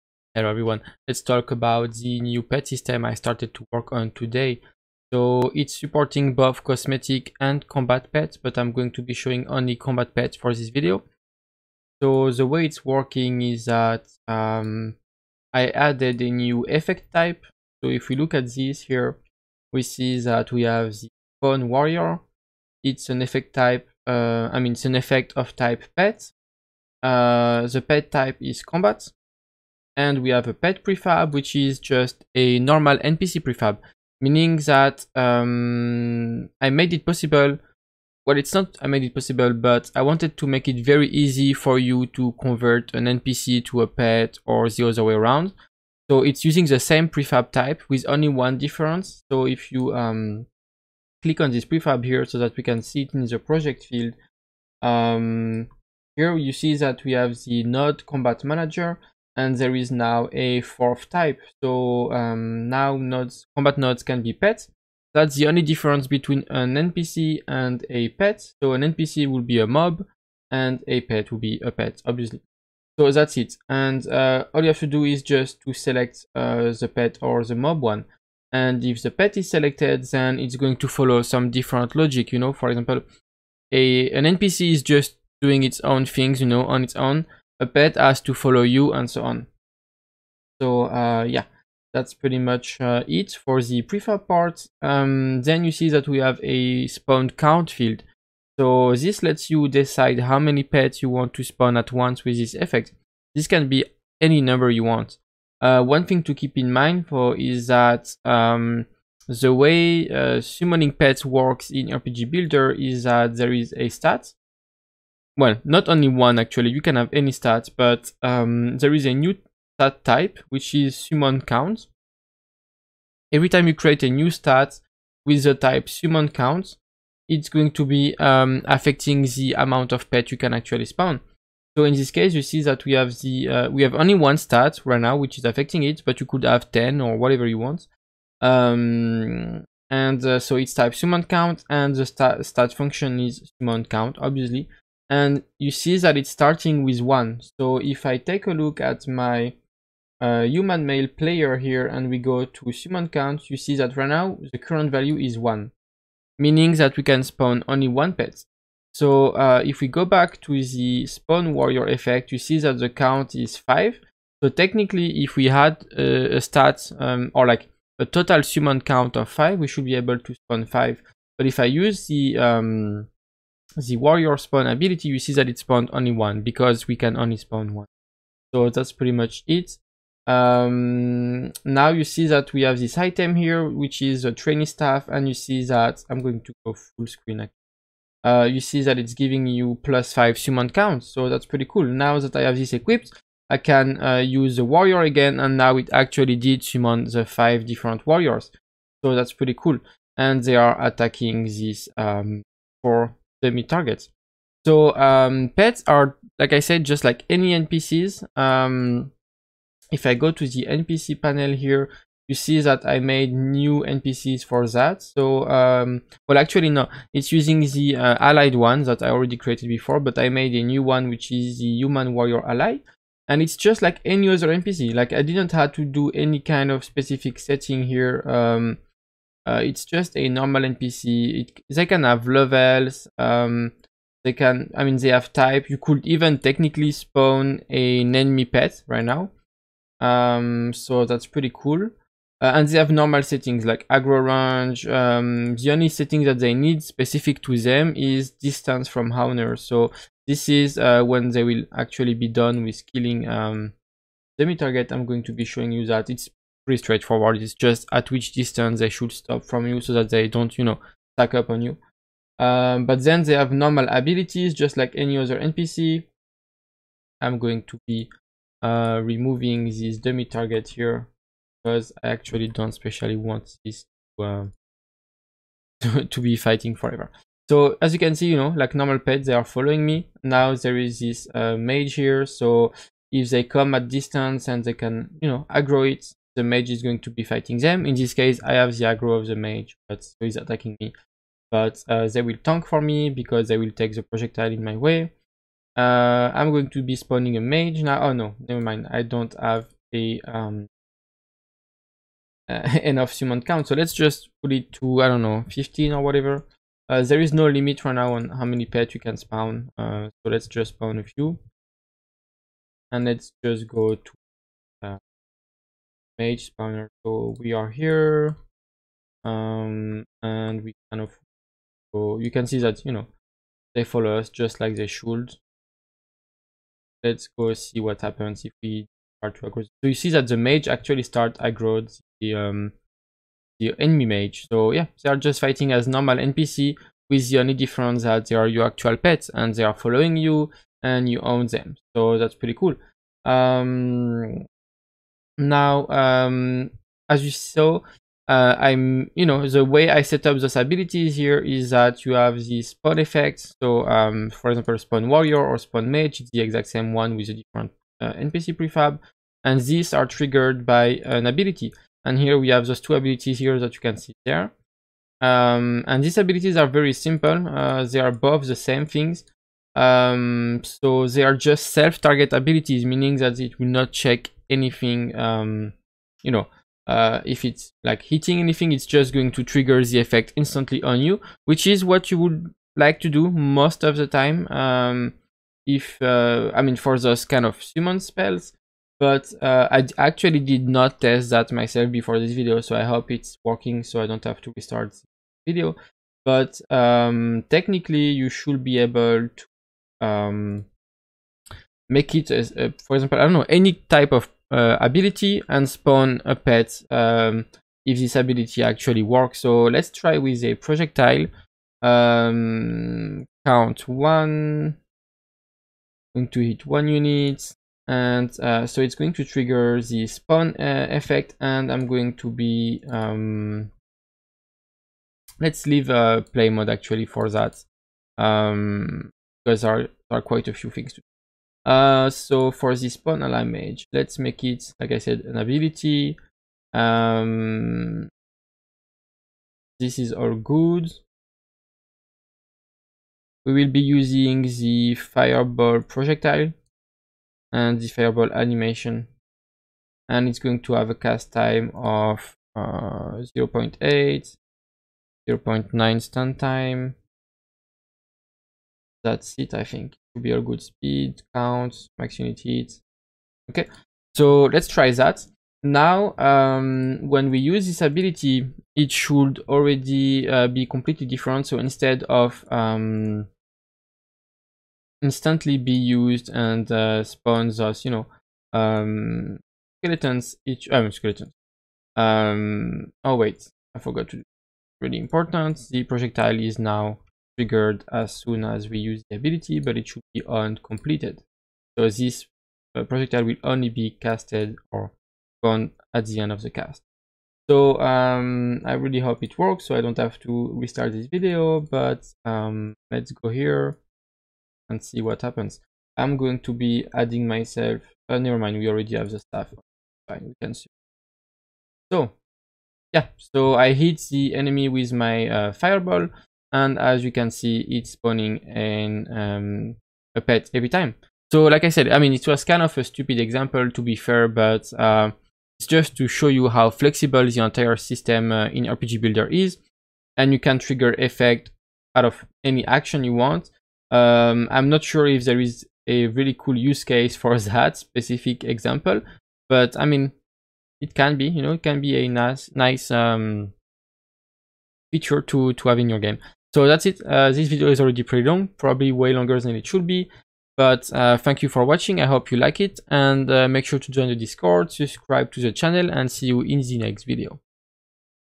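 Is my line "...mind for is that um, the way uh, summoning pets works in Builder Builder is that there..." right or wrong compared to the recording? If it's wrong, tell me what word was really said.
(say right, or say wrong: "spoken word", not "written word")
wrong: "RPG", not "Builder".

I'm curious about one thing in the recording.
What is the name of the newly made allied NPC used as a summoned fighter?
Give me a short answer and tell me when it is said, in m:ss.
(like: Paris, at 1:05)
human warrior ally, at 3:41.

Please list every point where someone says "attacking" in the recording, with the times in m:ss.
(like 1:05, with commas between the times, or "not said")
3:20, 4:50.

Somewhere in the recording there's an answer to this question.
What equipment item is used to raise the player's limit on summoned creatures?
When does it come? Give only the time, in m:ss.
3:04.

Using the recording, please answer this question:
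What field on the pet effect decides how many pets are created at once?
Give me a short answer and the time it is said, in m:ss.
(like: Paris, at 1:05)
spawn count, at 1:36.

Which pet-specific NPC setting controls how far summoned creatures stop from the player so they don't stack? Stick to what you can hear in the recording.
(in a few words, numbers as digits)
distance from owner.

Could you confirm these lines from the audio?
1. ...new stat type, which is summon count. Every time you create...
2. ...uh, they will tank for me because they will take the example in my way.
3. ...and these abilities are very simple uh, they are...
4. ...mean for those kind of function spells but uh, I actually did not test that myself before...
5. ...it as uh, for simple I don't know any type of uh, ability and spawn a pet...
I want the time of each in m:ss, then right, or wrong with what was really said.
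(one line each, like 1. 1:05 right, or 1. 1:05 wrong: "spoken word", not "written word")
1. 1:59 right
2. 4:51 wrong: "projectile", not "example"
3. 6:05 right
4. 6:26 wrong: "summon", not "function"
5. 6:42 wrong: "example", not "simple".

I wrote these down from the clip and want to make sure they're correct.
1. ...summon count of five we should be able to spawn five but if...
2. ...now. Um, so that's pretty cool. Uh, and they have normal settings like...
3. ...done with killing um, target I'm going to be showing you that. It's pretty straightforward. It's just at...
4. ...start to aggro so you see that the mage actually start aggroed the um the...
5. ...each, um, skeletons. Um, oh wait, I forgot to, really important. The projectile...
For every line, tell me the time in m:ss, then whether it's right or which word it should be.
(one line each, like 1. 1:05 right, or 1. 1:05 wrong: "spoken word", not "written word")
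1. 2:48 right
2. 3:59 right
3. 4:12 right
4. 5:29 right
5. 8:00 right.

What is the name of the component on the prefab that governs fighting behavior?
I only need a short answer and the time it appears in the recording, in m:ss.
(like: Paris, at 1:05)
node combat manager, at 0:57.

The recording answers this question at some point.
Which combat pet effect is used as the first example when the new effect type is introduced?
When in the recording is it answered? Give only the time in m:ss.
0:21.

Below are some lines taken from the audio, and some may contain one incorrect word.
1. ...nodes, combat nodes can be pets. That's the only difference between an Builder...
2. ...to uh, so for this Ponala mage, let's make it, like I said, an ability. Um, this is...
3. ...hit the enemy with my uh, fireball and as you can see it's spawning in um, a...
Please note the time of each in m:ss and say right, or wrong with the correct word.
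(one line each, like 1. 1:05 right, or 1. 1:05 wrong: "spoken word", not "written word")
1. 1:02 wrong: "NPC", not "Builder"
2. 7:10 right
3. 8:33 right.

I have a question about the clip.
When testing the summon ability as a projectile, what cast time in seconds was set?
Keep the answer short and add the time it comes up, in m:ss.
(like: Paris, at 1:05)
0.8, at 7:33.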